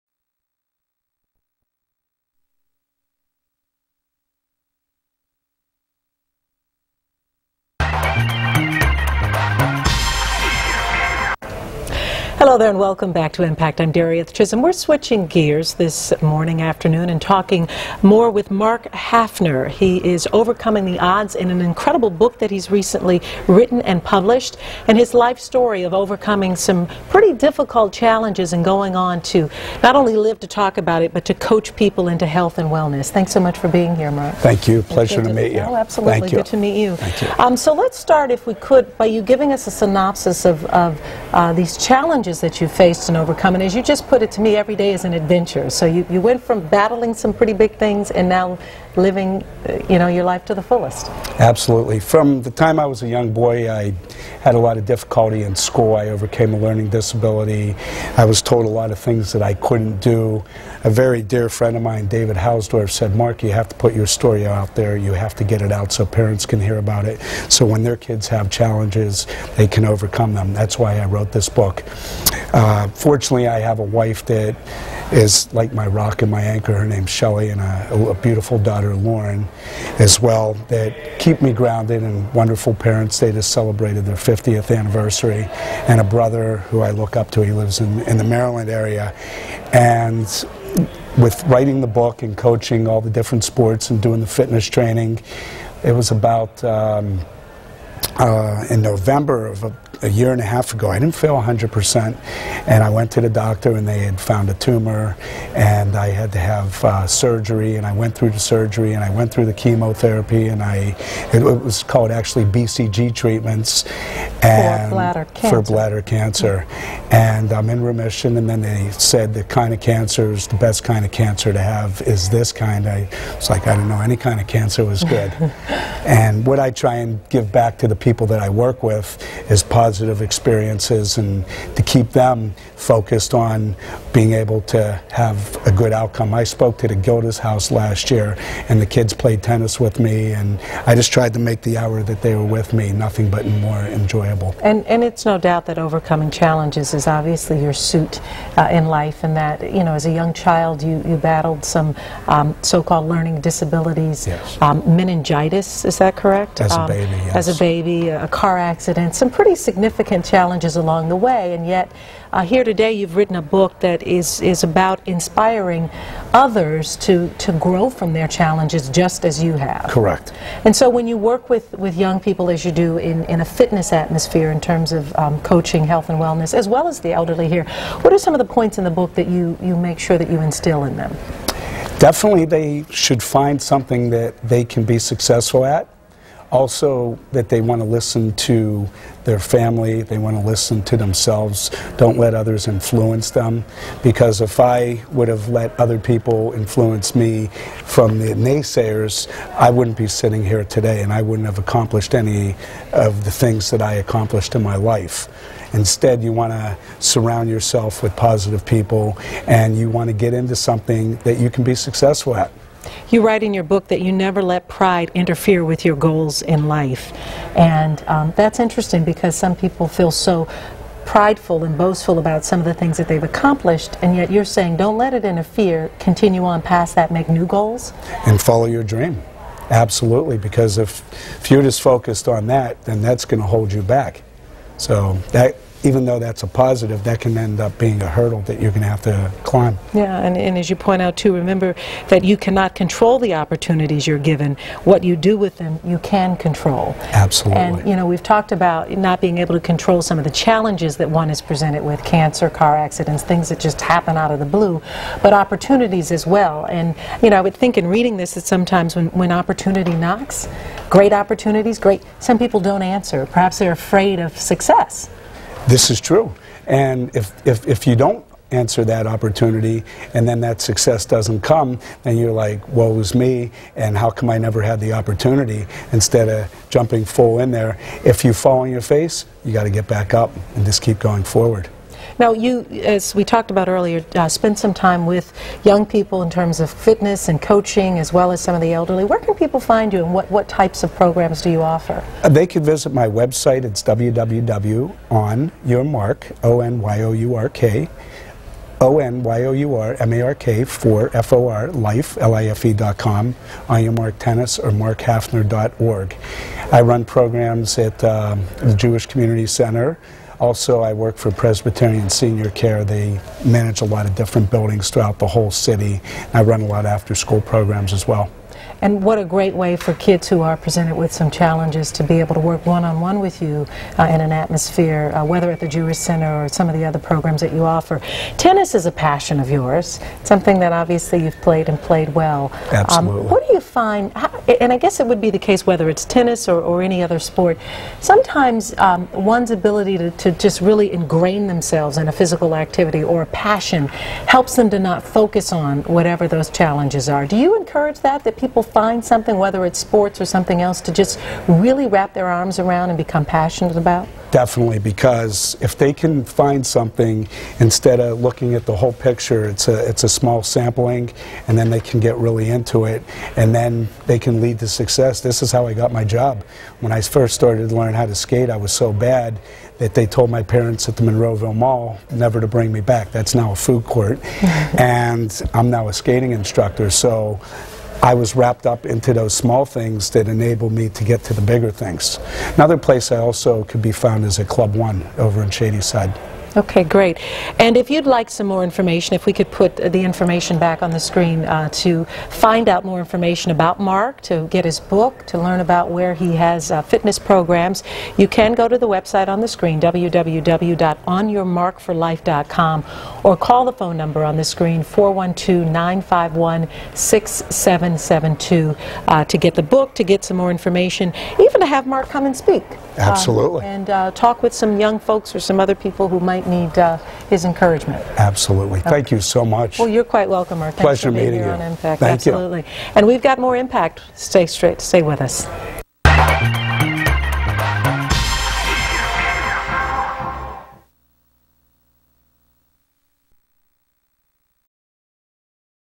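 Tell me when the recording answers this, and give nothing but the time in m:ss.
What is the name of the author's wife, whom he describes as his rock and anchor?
1:17.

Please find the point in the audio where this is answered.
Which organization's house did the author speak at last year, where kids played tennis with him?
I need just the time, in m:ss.
2:16.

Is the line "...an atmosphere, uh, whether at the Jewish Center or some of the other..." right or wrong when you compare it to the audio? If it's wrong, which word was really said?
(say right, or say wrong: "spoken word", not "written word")
right.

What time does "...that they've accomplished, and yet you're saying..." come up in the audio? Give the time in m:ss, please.
3:42.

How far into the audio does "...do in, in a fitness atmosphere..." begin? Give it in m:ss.
2:52.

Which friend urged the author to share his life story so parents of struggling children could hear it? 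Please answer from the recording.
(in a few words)
David Hausdorff.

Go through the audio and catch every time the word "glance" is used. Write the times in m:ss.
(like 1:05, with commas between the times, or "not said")
not said.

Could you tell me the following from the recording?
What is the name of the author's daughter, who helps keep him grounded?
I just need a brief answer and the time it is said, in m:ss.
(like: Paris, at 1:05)
Lauren, at 1:18.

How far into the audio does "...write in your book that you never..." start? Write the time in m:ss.
3:33.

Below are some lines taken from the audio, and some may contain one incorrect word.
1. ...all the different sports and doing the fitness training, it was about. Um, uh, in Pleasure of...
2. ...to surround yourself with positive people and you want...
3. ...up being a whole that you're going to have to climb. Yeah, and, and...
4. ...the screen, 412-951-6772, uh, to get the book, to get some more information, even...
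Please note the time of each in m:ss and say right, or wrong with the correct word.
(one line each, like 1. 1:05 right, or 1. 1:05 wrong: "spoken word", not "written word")
1. 1:32 wrong: "November", not "Pleasure"
2. 3:26 right
3. 3:57 wrong: "hurdle", not "whole"
4. 6:44 right.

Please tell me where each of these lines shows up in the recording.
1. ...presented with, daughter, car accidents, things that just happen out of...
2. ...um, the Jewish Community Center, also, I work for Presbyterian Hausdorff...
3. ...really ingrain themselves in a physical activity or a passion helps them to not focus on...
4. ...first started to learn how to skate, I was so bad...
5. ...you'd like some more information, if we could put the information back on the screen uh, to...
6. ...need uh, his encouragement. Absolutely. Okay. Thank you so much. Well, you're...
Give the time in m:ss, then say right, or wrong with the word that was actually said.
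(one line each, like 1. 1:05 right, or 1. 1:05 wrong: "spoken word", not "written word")
1. 4:11 wrong: "cancer", not "daughter"
2. 5:08 wrong: "Senior", not "Hausdorff"
3. 5:40 right
4. 6:07 right
5. 6:27 right
6. 6:56 right.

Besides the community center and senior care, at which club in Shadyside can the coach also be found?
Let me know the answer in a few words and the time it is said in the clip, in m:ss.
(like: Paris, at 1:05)
Club One, at 6:24.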